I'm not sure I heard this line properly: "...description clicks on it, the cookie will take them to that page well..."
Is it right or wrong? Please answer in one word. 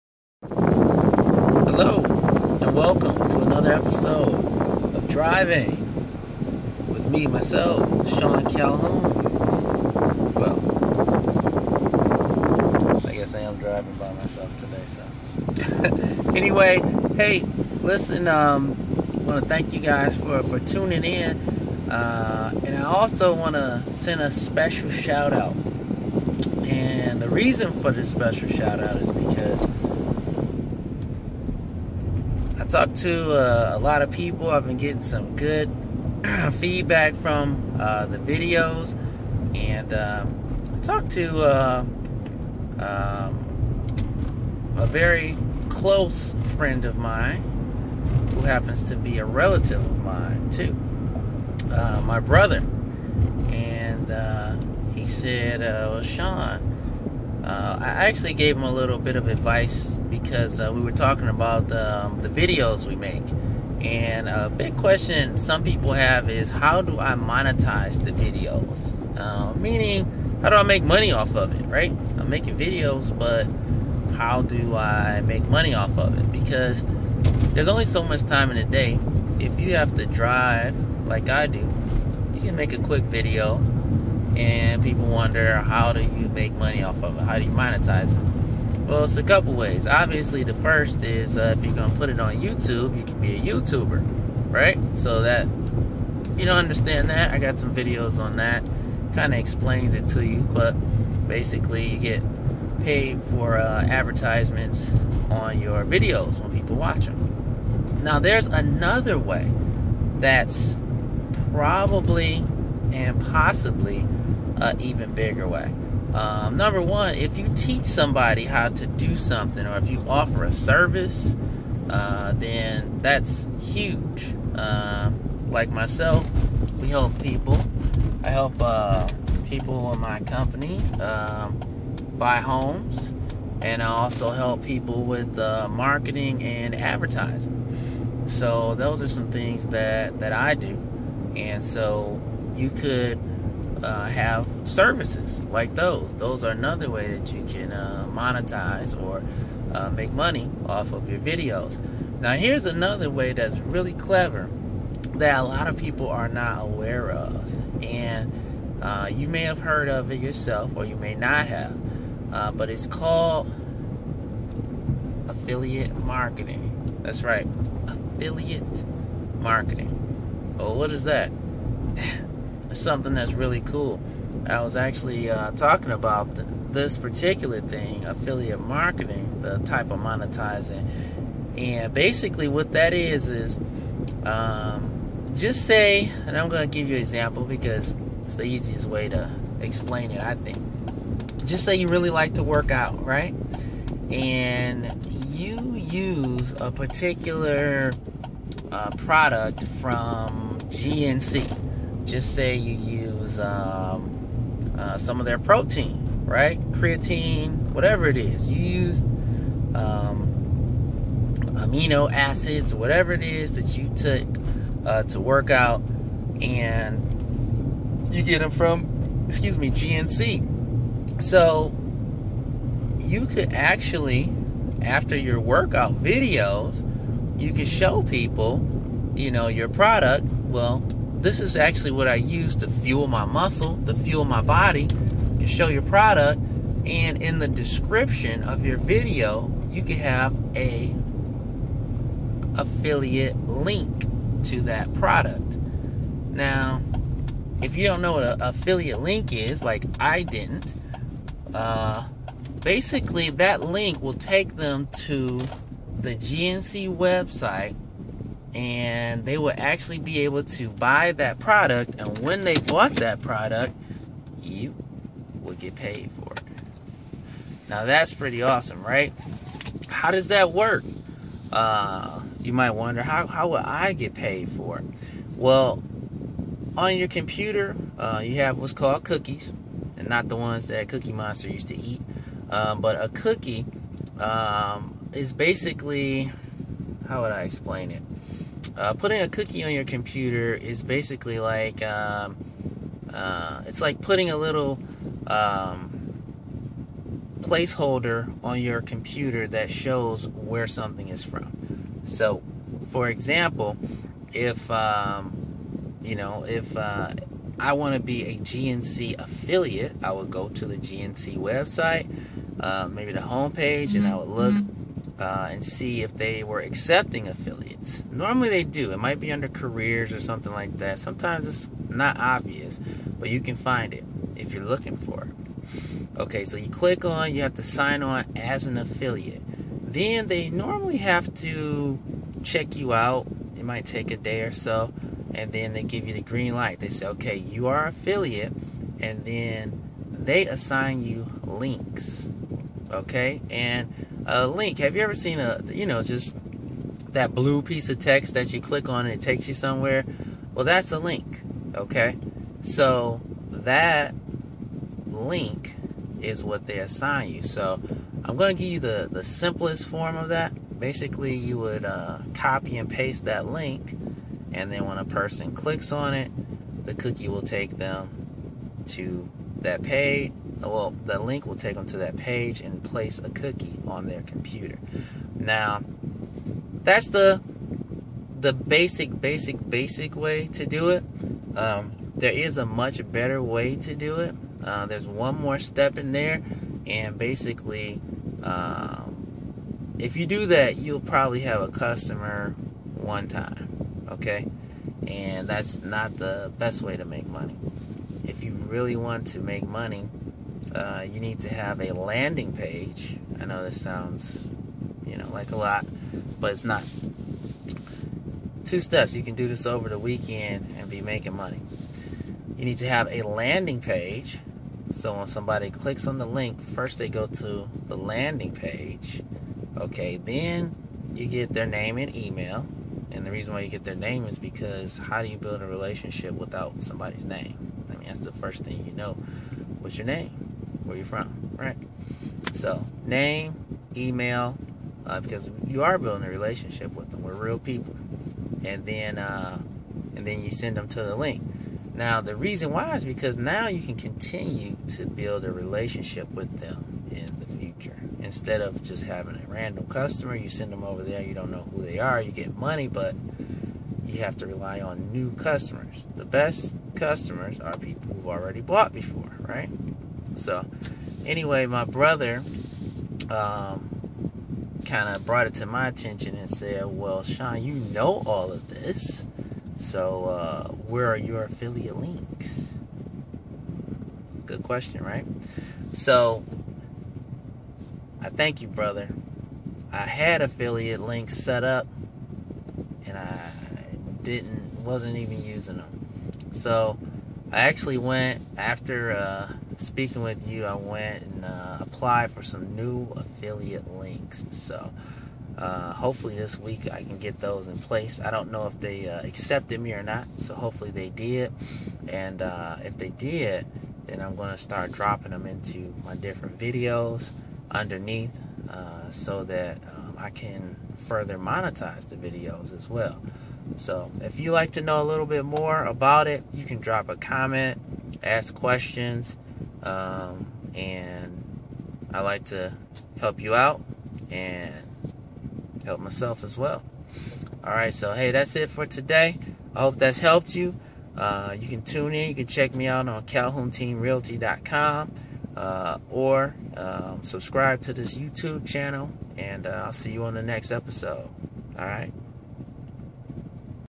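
wrong.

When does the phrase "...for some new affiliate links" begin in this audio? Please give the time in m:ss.
8:12.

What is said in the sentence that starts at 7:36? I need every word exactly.
The best customers are people who've already bought before, right?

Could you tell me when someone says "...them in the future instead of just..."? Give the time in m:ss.
7:26.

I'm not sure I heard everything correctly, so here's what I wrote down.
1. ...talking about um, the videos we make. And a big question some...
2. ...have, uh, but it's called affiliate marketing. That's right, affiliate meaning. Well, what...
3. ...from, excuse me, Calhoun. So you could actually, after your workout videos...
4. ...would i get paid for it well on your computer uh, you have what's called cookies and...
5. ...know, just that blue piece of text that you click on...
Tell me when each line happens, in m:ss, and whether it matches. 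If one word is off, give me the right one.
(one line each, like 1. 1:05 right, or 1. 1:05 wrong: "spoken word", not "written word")
1. 1:00 right
2. 2:41 wrong: "marketing", not "meaning"
3. 3:38 wrong: "GNC", not "Calhoun"
4. 4:33 right
5. 5:45 right.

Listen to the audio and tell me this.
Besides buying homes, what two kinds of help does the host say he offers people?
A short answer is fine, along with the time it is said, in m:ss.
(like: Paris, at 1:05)
Marketing and advertising, at 2:15.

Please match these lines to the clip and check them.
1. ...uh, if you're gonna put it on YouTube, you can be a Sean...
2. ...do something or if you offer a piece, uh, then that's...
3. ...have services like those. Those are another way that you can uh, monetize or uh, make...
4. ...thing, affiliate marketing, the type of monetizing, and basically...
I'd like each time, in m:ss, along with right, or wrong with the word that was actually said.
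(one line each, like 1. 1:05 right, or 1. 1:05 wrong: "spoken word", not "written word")
1. 1:31 wrong: "YouTuber", not "Sean"
2. 1:58 wrong: "service", not "piece"
3. 2:24 right
4. 2:57 right.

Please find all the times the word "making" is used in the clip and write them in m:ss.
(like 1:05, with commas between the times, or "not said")
1:12, 6:51.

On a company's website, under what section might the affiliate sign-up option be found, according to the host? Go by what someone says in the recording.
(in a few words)
Careers.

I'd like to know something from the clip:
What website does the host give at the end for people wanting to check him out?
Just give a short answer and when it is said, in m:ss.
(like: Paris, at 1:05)
CalhounTeamRealty.com, at 8:53.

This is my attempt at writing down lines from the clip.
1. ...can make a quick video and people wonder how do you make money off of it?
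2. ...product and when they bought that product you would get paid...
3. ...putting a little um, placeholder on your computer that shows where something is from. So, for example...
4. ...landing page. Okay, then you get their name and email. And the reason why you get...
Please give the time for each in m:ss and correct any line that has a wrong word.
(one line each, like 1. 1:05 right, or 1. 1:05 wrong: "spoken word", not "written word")
1. 1:22 right
2. 4:21 right
3. 4:54 right
4. 6:57 right.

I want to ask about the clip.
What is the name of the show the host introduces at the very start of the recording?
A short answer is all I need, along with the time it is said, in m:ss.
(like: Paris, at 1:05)
Driving with me, at 0:05.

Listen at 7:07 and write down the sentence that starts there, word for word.
I mean, that's the first thing you know.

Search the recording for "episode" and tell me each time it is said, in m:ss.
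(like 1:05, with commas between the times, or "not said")
0:03, 9:00.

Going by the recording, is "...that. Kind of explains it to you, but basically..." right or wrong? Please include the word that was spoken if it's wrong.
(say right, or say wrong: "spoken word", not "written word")
right.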